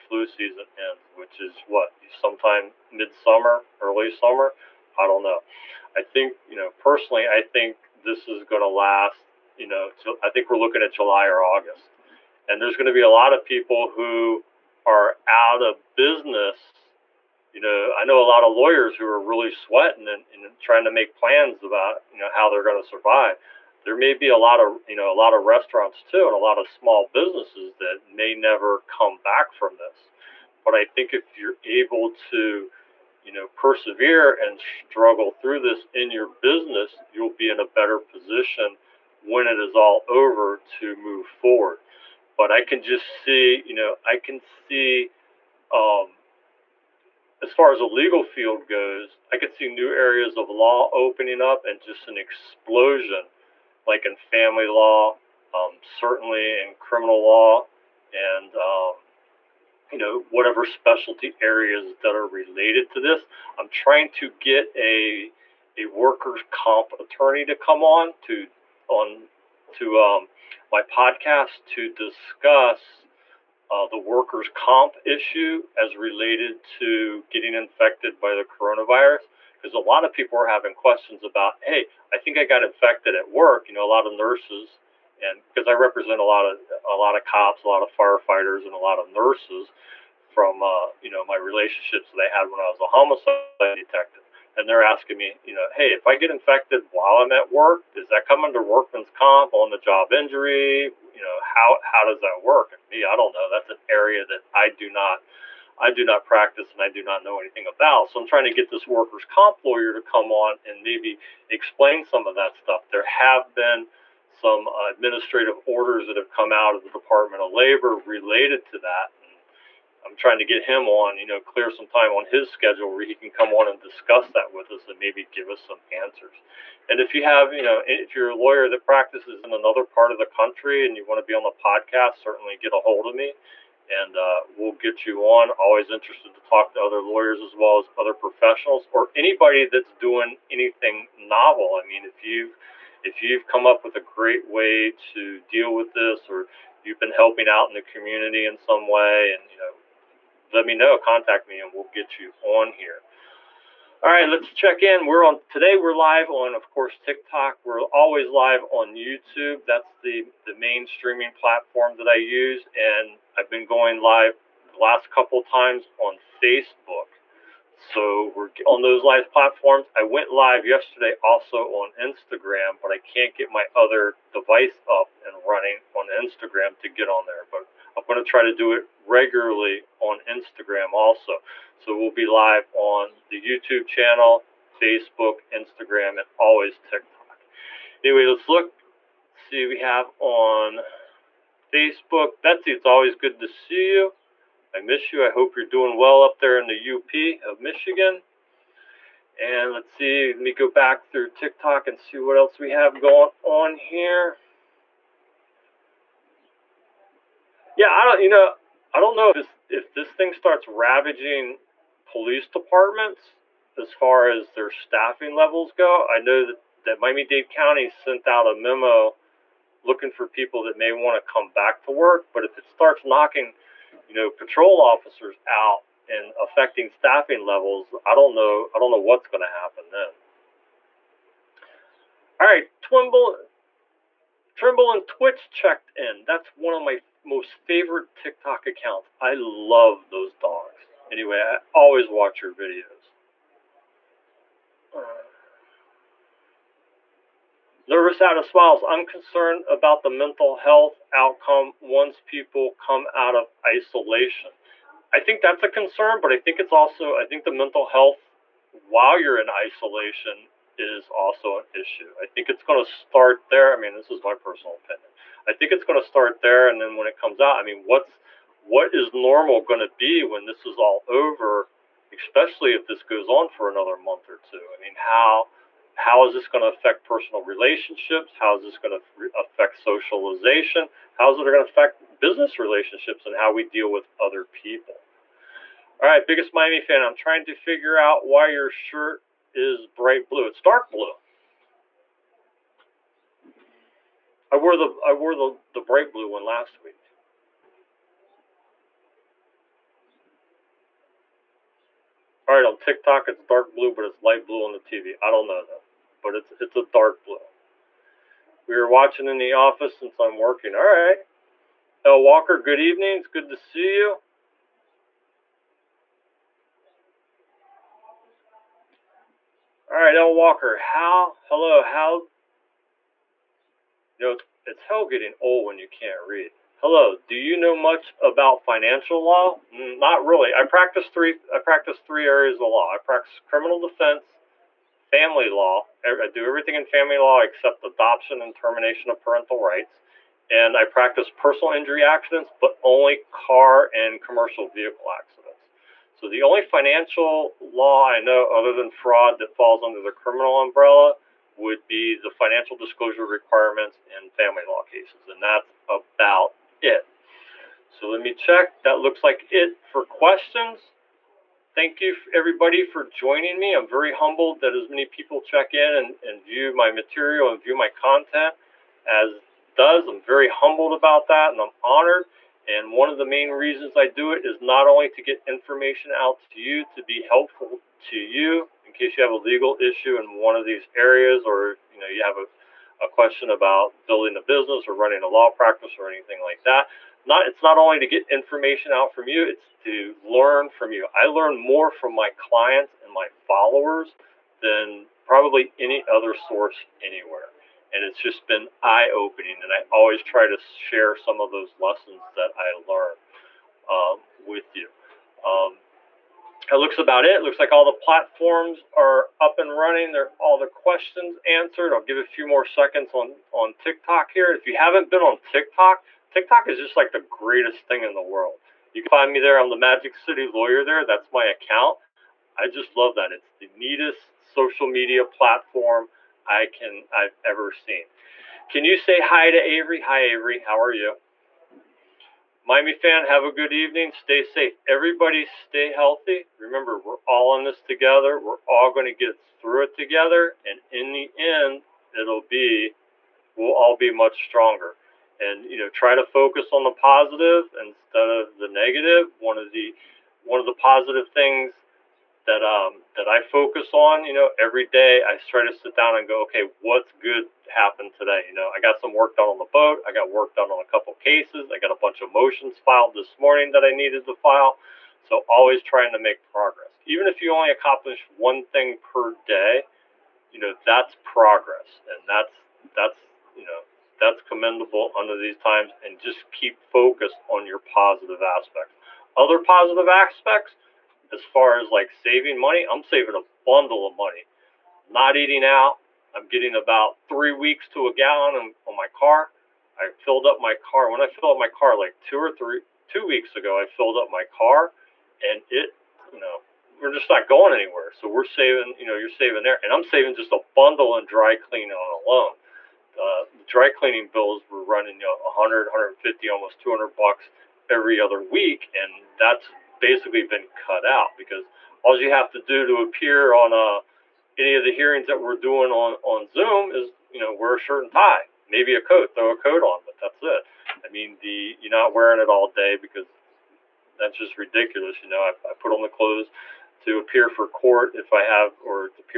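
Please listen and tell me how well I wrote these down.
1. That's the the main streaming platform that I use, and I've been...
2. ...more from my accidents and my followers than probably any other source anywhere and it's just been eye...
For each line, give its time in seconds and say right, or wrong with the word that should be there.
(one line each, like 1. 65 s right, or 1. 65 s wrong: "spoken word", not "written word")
1. 159 s right
2. 391 s wrong: "clients", not "accidents".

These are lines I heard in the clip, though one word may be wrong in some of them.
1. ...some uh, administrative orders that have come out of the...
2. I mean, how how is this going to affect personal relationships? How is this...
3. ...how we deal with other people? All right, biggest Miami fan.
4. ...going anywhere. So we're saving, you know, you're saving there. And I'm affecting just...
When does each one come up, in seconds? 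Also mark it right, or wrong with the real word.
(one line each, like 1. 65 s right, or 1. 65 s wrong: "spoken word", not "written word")
1. 114 s right
2. 274 s right
3. 283 s right
4. 497 s wrong: "saving", not "affecting".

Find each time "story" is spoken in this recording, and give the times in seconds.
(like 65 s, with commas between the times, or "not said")
not said.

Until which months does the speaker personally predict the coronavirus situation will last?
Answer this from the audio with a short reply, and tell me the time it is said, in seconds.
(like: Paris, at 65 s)
July or August, at 10 s.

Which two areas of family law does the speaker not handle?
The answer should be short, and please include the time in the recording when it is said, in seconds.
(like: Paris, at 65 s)
Adoption and termination of parental rights, at 337 s.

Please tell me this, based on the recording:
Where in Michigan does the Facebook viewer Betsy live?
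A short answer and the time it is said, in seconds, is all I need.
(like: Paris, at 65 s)
the UP, at 196 s.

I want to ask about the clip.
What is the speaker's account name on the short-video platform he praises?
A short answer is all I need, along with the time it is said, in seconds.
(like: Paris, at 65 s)
Magic City Lawyer, at 419 s.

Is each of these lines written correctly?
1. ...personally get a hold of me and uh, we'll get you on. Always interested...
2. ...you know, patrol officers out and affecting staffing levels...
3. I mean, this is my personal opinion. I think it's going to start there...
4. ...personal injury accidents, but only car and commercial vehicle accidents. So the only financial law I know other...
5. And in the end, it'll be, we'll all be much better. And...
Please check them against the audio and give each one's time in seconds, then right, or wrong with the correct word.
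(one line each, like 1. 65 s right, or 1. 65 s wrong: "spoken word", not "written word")
1. 132 s wrong: "certainly", not "personally"
2. 224 s right
3. 263 s right
4. 341 s right
5. 440 s wrong: "stronger", not "better".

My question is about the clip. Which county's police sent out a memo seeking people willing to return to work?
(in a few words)
Miami Dade County.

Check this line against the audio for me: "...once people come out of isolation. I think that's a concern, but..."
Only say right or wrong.
right.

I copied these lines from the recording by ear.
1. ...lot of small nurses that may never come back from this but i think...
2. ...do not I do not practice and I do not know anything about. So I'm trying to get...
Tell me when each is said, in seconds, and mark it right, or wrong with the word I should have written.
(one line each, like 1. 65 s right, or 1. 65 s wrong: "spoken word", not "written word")
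1. 26 s wrong: "businesses", not "nurses"
2. 104 s right.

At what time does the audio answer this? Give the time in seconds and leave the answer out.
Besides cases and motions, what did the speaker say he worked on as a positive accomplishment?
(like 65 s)
459 s.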